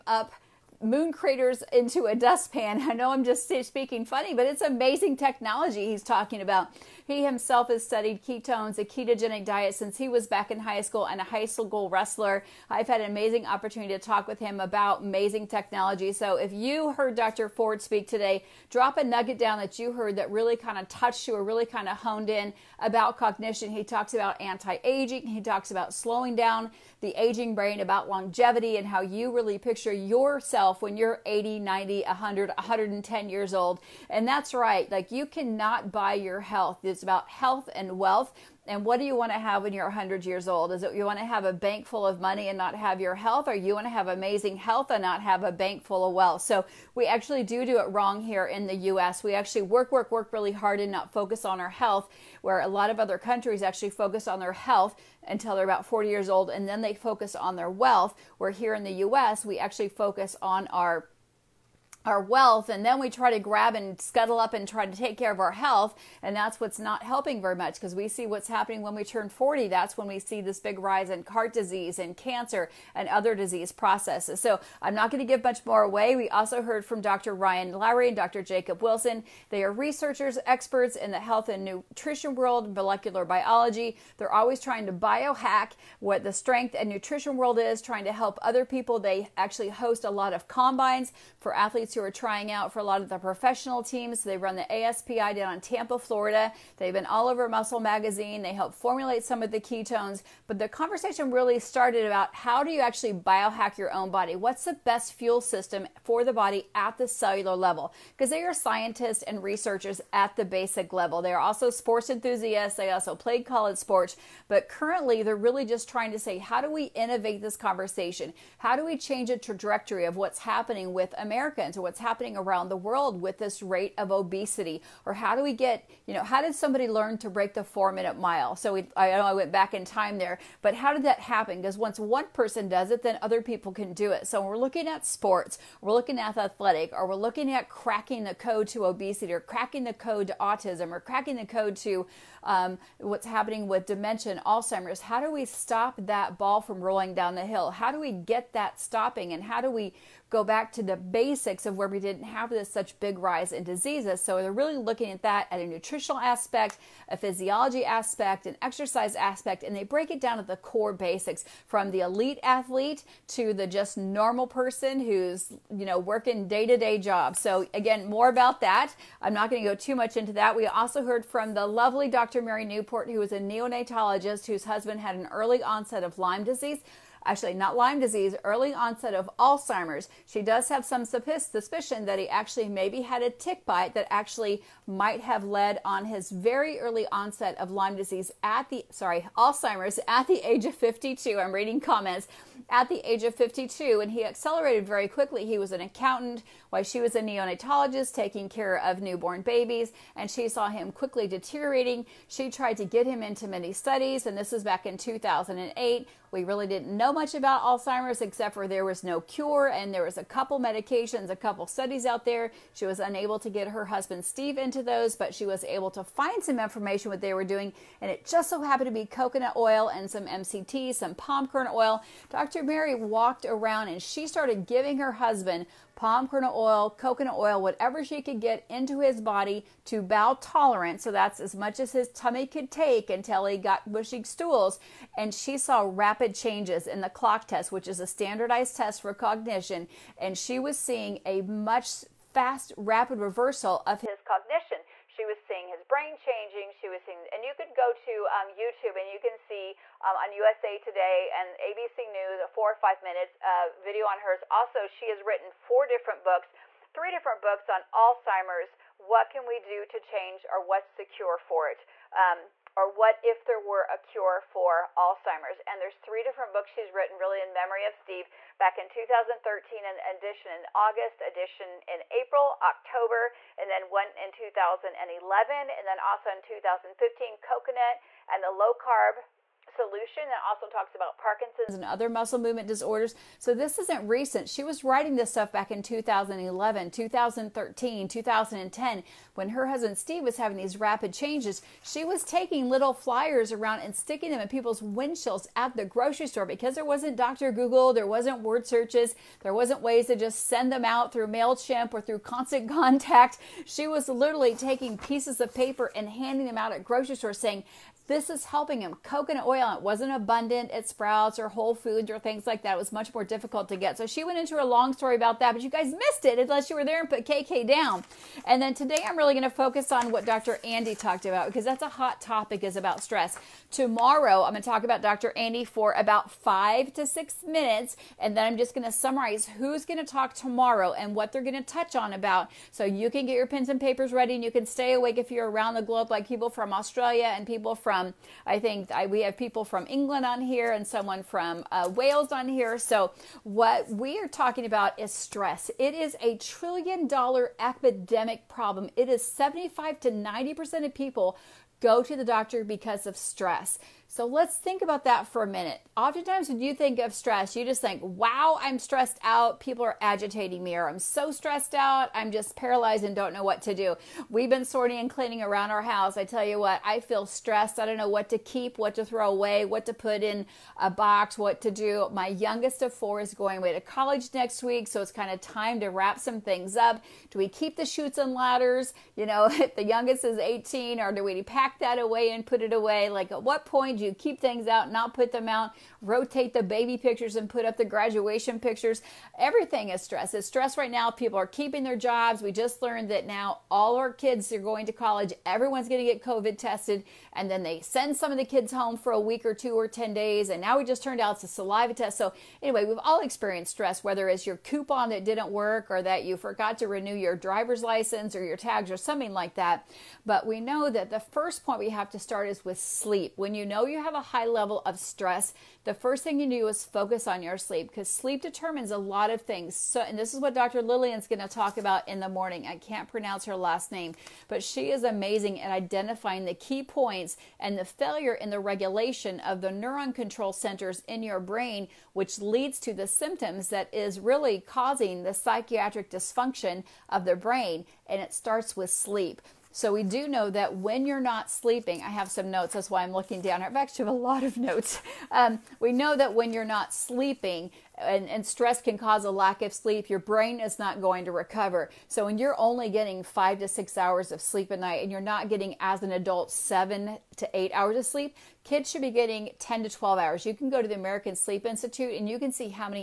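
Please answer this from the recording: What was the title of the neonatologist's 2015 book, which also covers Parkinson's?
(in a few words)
Coconut and the Low Carb solution.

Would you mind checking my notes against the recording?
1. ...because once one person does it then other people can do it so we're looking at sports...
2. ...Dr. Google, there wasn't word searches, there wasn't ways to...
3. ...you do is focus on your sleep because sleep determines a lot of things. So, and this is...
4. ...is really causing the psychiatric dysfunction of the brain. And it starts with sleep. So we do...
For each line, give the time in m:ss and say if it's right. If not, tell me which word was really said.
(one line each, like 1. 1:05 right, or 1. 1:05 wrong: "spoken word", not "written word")
1. 2:11 right
2. 4:57 right
3. 6:56 right
4. 7:13 right.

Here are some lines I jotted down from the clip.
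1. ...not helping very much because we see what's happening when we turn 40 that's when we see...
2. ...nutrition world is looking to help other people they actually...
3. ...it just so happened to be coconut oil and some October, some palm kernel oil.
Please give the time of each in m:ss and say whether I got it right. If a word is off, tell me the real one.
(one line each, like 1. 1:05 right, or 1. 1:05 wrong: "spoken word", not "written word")
1. 1:06 right
2. 1:26 wrong: "trying", not "looking"
3. 3:38 wrong: "MCT", not "October".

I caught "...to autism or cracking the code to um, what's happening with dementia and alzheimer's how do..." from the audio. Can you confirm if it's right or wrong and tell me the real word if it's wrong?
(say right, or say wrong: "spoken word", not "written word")
right.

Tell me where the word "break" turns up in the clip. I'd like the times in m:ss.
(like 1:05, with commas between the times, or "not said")
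2:07, 2:39.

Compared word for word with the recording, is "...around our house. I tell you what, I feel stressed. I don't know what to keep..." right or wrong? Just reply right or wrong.
right.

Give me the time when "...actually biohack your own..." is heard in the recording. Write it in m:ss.
1:42.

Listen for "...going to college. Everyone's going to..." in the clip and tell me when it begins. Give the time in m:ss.
6:34.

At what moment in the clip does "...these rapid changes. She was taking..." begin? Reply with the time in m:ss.
4:50.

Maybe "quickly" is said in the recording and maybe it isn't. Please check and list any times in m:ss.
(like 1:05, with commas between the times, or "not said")
3:15, 3:20.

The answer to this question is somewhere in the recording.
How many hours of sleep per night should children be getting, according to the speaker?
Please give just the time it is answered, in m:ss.
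7:39.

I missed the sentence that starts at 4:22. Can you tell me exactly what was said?
Um, or What If There Were a Cure for Alzheimer's?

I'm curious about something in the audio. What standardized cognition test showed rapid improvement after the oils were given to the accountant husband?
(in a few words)
clock test.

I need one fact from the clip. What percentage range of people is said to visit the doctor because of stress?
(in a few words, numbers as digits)
75 to 90%.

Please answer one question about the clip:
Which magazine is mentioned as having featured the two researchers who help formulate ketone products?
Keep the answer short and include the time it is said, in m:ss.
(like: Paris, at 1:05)
Muscle Magazine, at 1:37.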